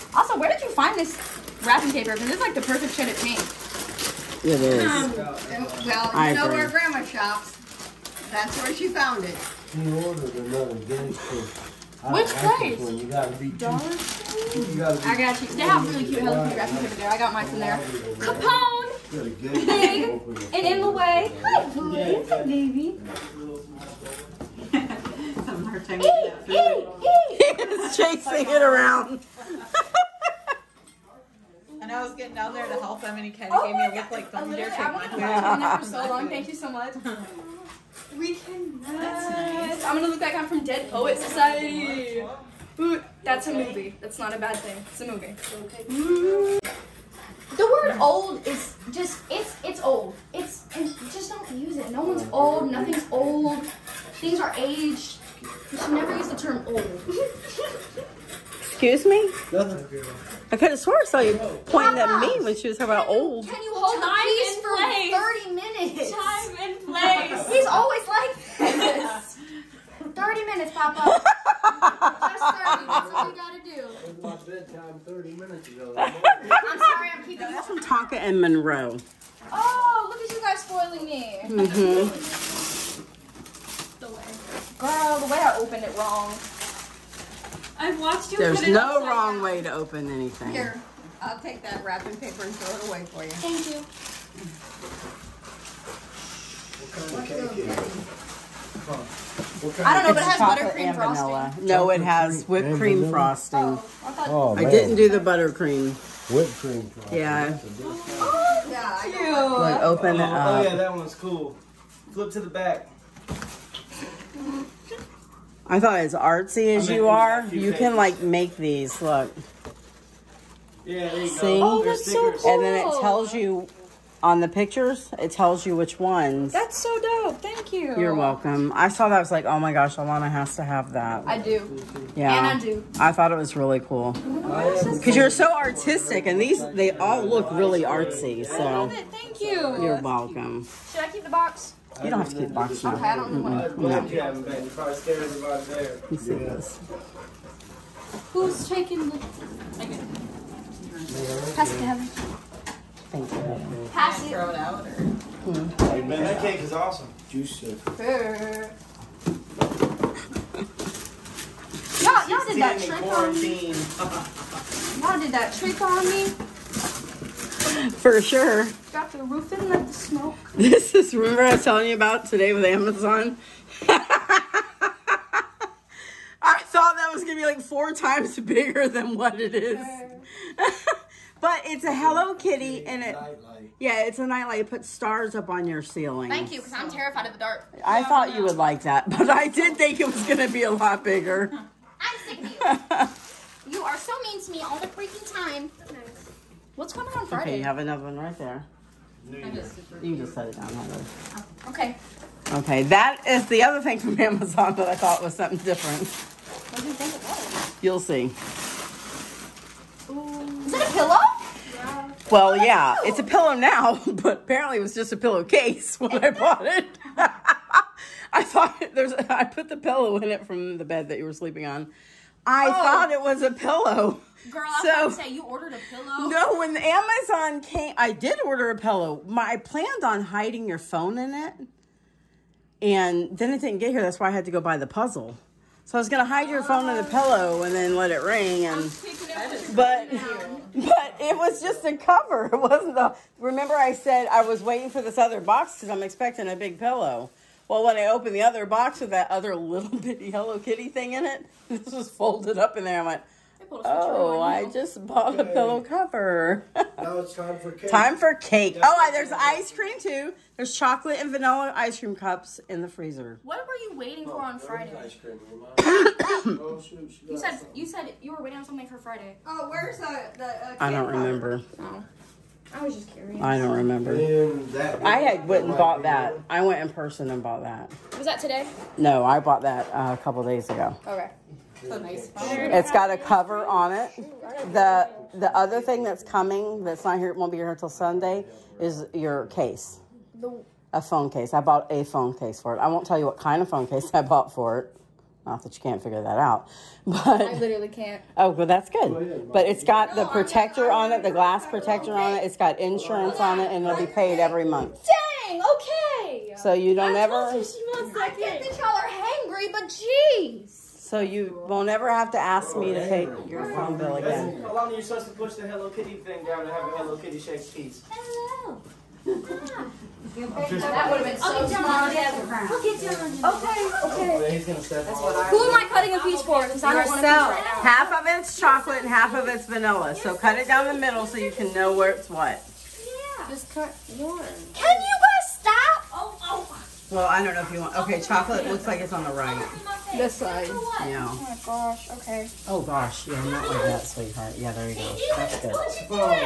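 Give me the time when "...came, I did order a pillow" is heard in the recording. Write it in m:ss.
3:47.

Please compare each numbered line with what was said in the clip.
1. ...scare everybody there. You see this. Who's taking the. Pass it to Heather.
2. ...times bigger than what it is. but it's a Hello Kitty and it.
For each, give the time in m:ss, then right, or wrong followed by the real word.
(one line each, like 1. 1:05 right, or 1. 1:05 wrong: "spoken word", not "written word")
1. 2:24 right
2. 2:57 right.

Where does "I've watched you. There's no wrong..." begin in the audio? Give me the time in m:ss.
1:27.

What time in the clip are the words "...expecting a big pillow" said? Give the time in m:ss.
4:06.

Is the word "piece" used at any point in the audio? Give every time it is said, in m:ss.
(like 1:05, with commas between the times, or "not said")
5:17, 5:26.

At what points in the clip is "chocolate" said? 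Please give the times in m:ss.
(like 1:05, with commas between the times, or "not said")
4:20, 5:28, 5:38.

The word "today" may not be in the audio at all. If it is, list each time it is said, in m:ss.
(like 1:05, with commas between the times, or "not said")
2:52, 4:38.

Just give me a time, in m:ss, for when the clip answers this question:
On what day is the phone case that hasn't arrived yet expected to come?
4:47.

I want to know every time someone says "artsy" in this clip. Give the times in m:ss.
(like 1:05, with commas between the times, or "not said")
1:56, 2:17.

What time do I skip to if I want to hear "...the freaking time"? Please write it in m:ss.
3:14.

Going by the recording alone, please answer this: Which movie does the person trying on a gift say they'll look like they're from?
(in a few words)
Dead Poet Society.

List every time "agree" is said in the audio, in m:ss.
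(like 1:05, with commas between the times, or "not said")
0:06.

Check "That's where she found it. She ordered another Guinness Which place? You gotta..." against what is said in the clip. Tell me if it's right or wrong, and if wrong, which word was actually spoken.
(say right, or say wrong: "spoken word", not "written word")
right.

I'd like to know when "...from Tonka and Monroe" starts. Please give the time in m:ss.
1:17.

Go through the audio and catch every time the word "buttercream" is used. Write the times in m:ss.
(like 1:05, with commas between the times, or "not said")
1:40, 1:45.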